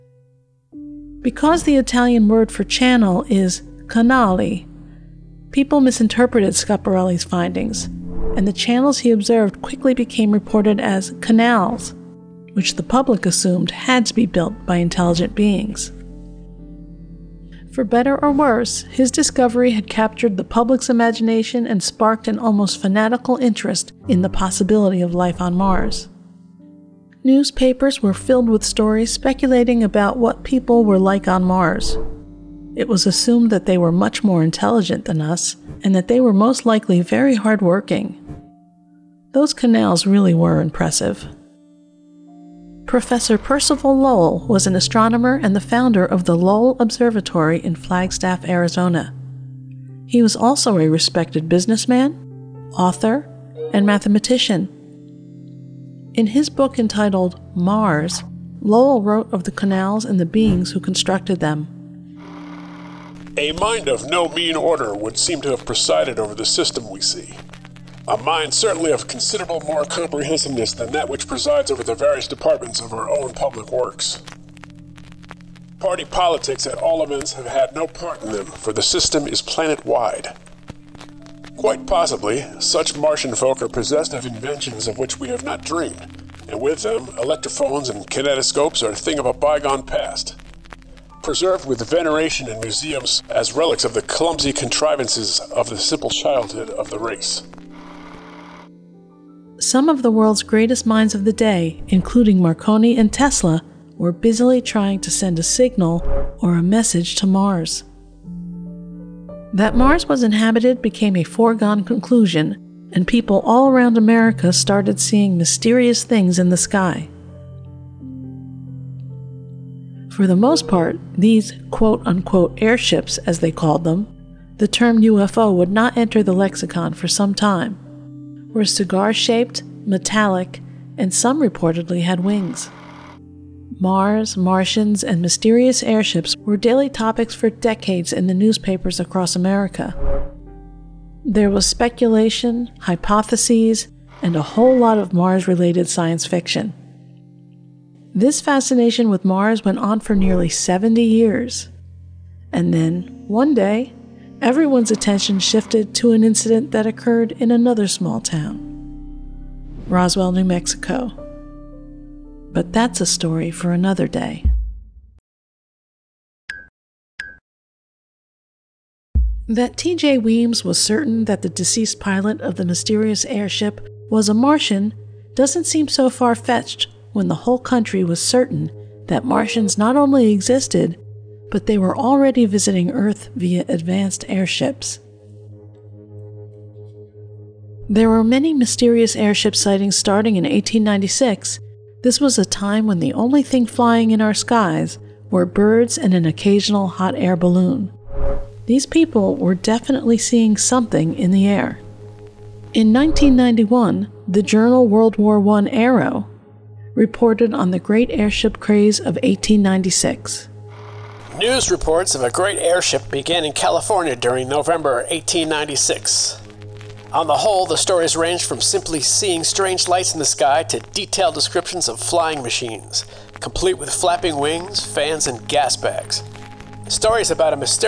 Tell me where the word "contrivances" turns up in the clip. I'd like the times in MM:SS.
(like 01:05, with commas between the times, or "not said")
01:34.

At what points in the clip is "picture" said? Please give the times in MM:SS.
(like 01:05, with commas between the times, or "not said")
not said.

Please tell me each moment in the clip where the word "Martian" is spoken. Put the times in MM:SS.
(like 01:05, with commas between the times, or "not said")
01:22, 02:14, 02:54, 02:59.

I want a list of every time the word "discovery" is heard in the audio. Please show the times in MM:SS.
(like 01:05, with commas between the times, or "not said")
00:19.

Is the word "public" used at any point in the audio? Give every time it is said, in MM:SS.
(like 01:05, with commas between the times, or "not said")
00:12, 00:20, 01:13.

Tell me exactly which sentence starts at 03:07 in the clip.
There were many mysterious airship sightings starting in 1896.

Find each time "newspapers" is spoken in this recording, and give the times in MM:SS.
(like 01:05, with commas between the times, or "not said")
00:27, 02:18.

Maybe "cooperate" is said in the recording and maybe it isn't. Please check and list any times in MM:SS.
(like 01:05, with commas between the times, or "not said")
not said.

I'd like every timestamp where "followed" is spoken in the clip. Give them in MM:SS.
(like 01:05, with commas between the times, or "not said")
not said.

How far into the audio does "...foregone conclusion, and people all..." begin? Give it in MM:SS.
01:51.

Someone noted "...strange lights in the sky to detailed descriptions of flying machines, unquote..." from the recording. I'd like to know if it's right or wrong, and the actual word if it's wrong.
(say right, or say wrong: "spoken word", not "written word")
wrong: "complete", not "unquote".